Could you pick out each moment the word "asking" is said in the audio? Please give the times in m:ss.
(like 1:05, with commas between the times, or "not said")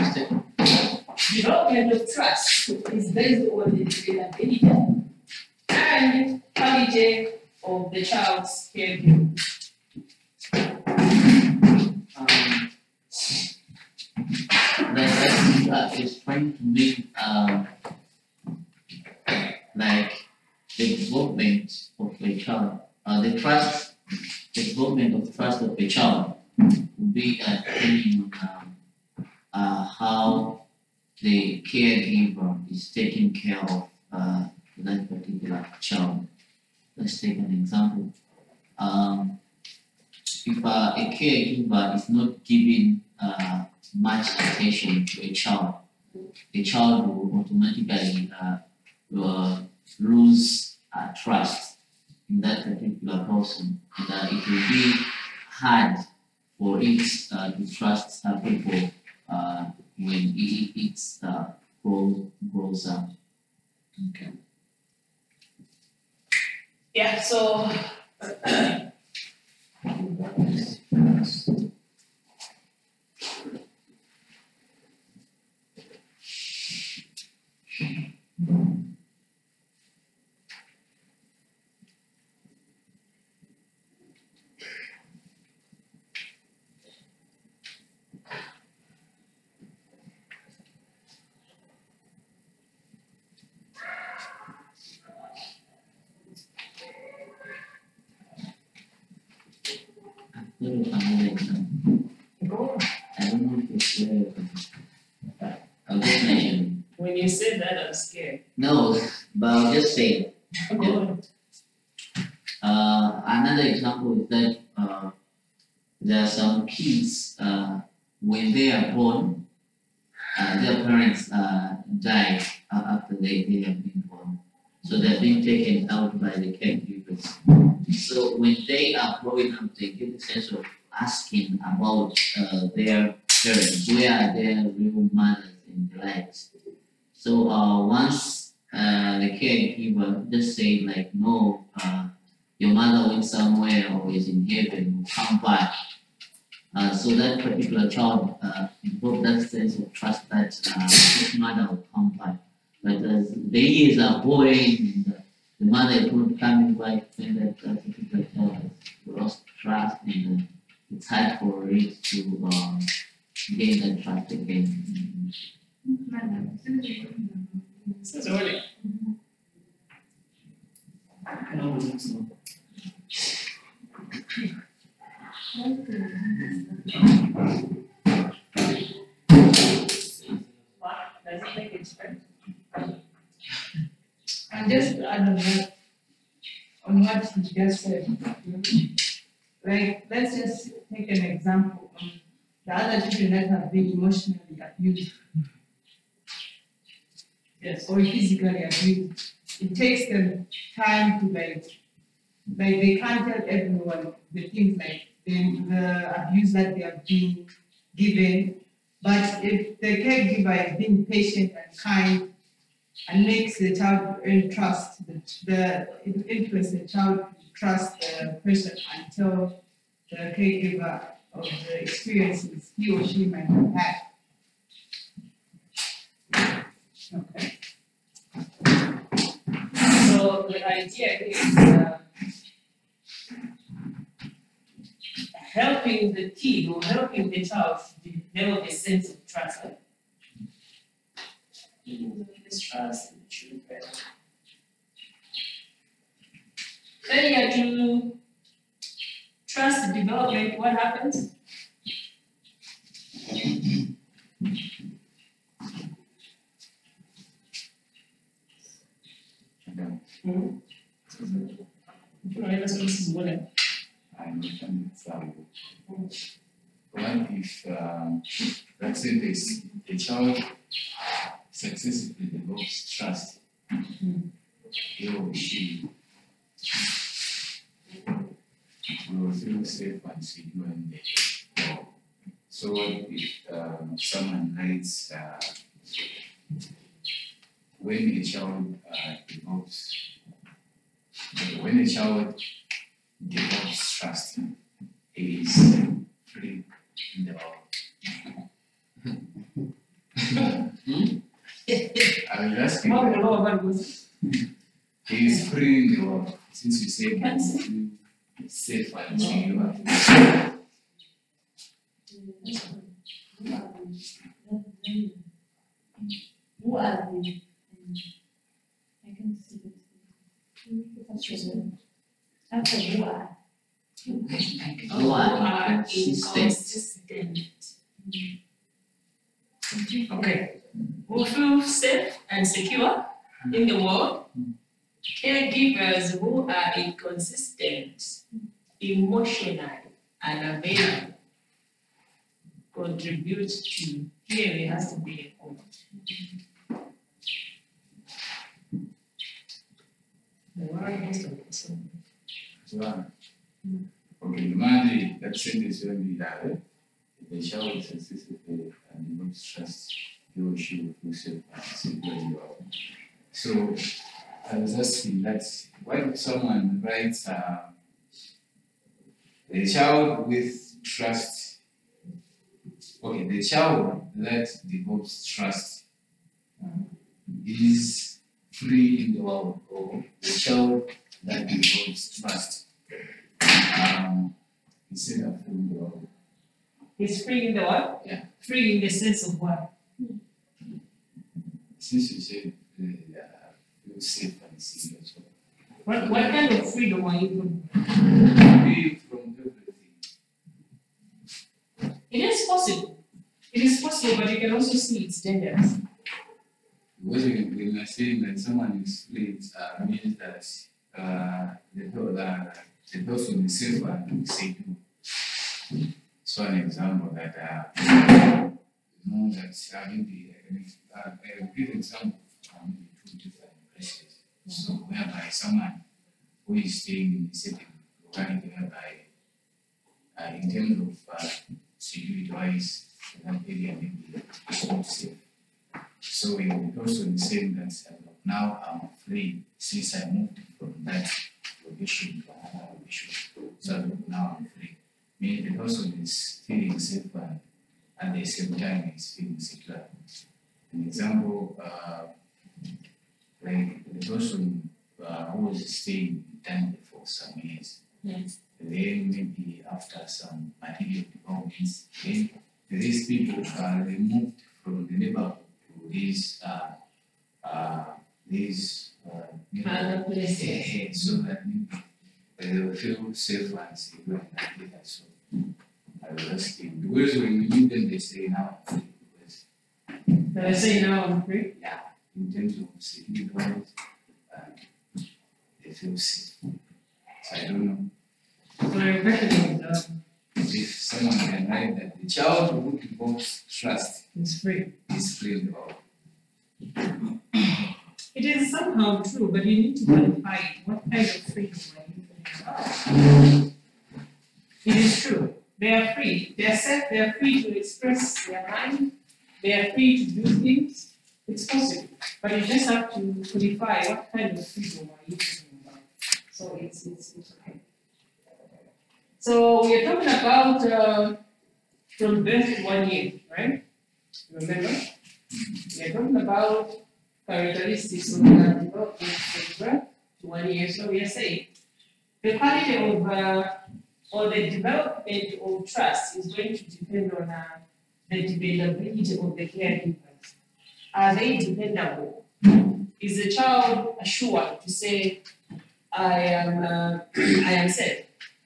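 2:10, 5:02.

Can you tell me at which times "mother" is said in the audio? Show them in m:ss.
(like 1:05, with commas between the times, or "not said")
2:15, 2:22, 2:31, 2:35.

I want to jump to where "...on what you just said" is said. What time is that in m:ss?
3:06.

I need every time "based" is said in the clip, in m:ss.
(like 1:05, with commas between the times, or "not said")
0:03.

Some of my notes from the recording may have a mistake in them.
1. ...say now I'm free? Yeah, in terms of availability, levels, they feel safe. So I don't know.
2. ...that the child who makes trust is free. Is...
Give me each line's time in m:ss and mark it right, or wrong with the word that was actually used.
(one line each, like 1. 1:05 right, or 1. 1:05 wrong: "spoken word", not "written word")
1. 8:00 wrong: "security", not "availability"
2. 8:11 wrong: "involves", not "makes".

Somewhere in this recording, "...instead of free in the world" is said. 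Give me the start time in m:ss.
6:24.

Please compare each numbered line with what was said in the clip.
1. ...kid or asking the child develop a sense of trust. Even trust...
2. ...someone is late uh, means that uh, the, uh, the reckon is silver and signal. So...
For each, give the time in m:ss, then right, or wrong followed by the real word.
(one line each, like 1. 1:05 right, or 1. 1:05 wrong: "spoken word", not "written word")
1. 3:56 wrong: "helping", not "asking"
2. 6:48 wrong: "person", not "reckon".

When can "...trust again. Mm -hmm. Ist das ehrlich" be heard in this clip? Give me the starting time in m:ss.
2:44.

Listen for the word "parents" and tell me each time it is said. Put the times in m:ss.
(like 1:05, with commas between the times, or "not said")
2:00, 2:13.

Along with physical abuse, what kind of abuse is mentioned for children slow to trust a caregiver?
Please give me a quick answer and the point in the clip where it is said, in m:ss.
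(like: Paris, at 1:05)
emotionally abused, at 3:13.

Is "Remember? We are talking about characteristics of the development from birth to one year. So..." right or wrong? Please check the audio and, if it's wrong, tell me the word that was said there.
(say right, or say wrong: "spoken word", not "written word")
right.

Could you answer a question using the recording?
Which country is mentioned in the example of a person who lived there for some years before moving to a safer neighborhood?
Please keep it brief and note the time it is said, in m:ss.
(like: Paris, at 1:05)
Tanzania, at 7:36.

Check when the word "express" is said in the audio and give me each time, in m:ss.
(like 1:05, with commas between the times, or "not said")
8:27.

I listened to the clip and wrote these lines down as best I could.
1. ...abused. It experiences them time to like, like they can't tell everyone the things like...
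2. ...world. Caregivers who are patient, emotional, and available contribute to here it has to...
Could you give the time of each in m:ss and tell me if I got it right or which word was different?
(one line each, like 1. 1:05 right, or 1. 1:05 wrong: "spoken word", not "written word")
1. 3:18 wrong: "takes", not "experiences"
2. 5:33 wrong: "inconsistent", not "patient".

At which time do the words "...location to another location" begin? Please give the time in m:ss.
7:21.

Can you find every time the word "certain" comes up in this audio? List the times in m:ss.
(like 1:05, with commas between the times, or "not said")
7:08.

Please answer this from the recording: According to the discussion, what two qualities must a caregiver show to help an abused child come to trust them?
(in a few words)
patient and kind.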